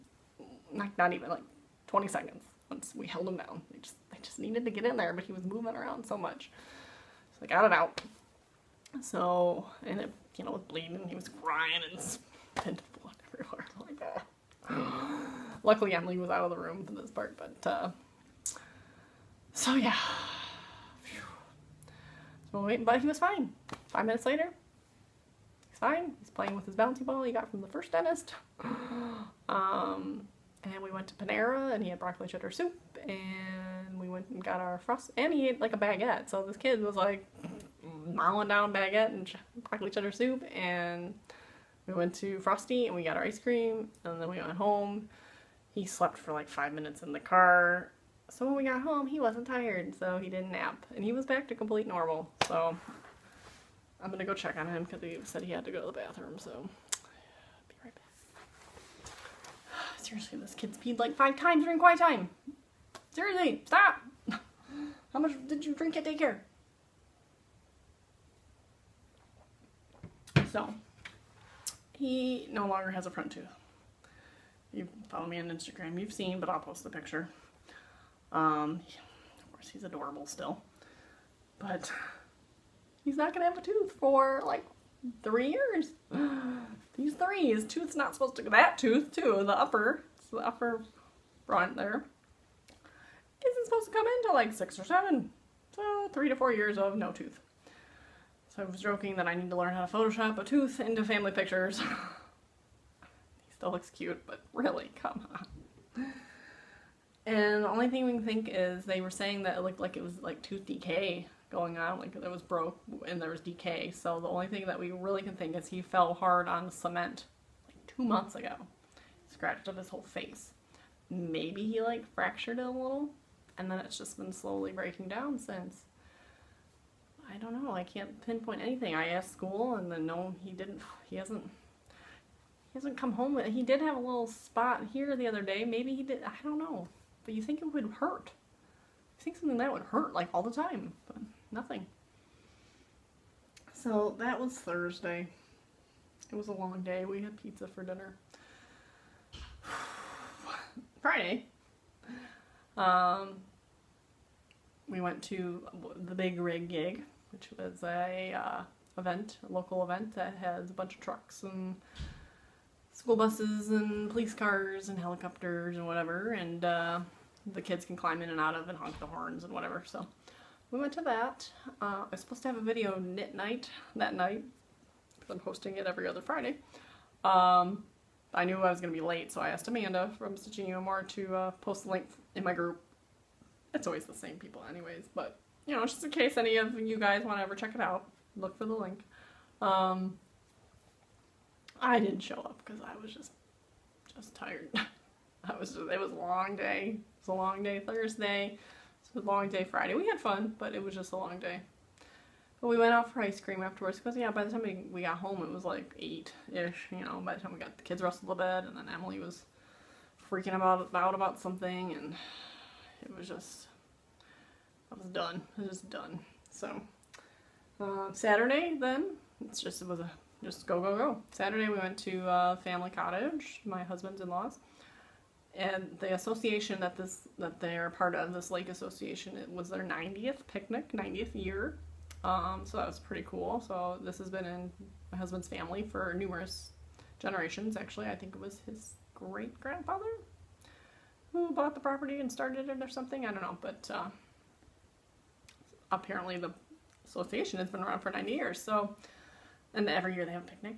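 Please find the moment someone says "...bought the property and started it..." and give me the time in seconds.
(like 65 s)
241 s.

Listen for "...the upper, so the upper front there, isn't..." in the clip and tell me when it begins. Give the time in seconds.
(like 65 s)
89 s.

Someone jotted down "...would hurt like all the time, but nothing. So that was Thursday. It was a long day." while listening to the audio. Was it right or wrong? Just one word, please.
right.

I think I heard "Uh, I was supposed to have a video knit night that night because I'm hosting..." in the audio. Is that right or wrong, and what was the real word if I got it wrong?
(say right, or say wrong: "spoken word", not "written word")
right.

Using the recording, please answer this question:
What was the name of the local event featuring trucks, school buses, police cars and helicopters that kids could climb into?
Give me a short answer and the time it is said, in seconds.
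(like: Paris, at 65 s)
Big Rig Gig, at 156 s.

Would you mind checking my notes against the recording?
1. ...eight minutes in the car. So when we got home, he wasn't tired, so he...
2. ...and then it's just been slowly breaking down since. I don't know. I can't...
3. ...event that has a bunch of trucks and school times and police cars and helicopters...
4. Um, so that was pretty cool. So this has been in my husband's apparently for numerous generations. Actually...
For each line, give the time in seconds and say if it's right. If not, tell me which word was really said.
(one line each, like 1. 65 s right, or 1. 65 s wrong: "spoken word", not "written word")
1. 46 s wrong: "five", not "eight"
2. 123 s right
3. 159 s wrong: "buses", not "times"
4. 232 s wrong: "family", not "apparently".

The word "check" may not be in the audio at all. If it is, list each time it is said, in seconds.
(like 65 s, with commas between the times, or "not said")
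54 s, 187 s.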